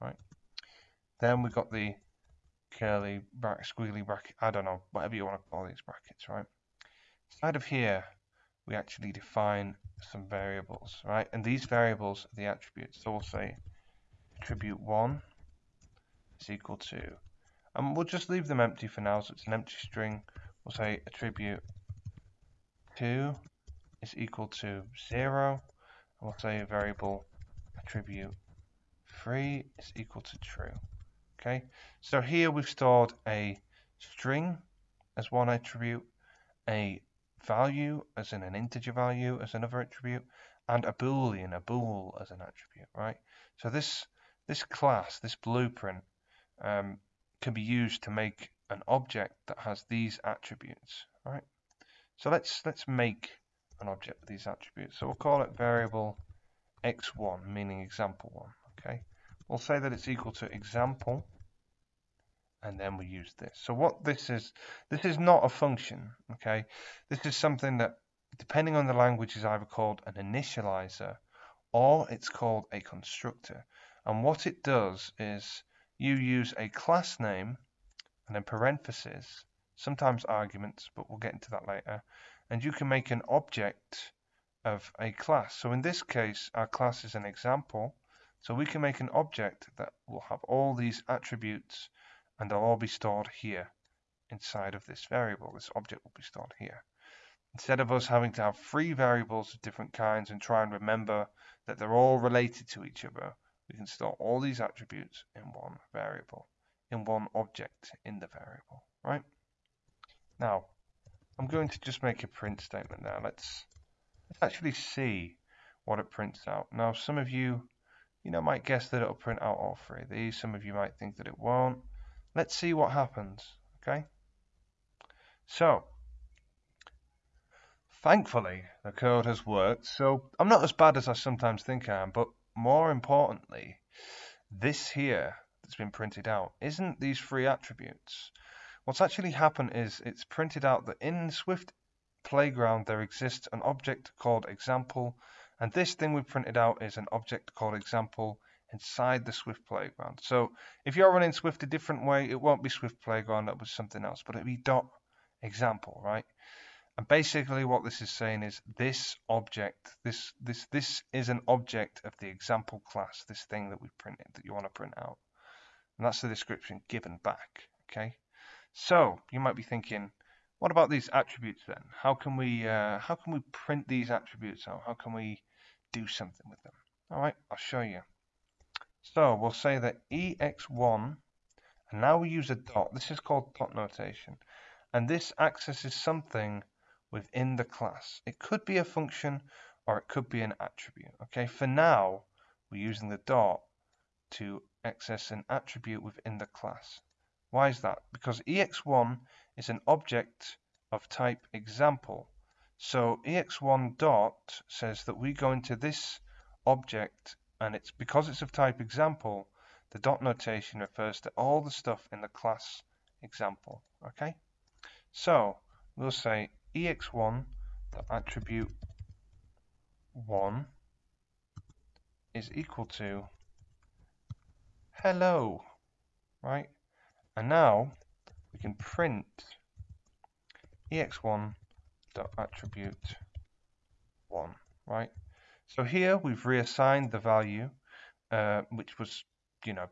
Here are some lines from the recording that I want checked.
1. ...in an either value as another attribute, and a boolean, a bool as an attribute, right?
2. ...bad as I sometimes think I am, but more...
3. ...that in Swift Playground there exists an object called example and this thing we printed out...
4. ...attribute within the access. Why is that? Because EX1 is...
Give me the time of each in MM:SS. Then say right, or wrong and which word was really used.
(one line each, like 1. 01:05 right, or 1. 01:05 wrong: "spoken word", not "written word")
1. 00:38 wrong: "integer", not "either"
2. 02:10 right
3. 02:20 right
4. 03:15 wrong: "class", not "access".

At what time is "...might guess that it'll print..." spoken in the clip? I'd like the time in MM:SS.
01:58.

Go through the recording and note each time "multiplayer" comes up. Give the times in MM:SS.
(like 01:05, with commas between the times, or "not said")
not said.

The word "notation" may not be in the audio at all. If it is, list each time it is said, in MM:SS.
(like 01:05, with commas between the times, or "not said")
03:03, 03:30.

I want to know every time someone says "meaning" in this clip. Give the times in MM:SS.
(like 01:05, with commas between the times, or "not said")
00:57.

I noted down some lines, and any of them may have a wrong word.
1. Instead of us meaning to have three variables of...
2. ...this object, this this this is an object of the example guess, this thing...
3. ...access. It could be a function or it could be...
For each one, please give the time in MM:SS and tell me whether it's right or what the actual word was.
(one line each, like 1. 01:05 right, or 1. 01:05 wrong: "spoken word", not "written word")
1. 01:37 wrong: "having", not "meaning"
2. 02:38 wrong: "class", not "guess"
3. 03:07 wrong: "class", not "access".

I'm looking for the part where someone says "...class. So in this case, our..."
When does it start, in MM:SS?
01:25.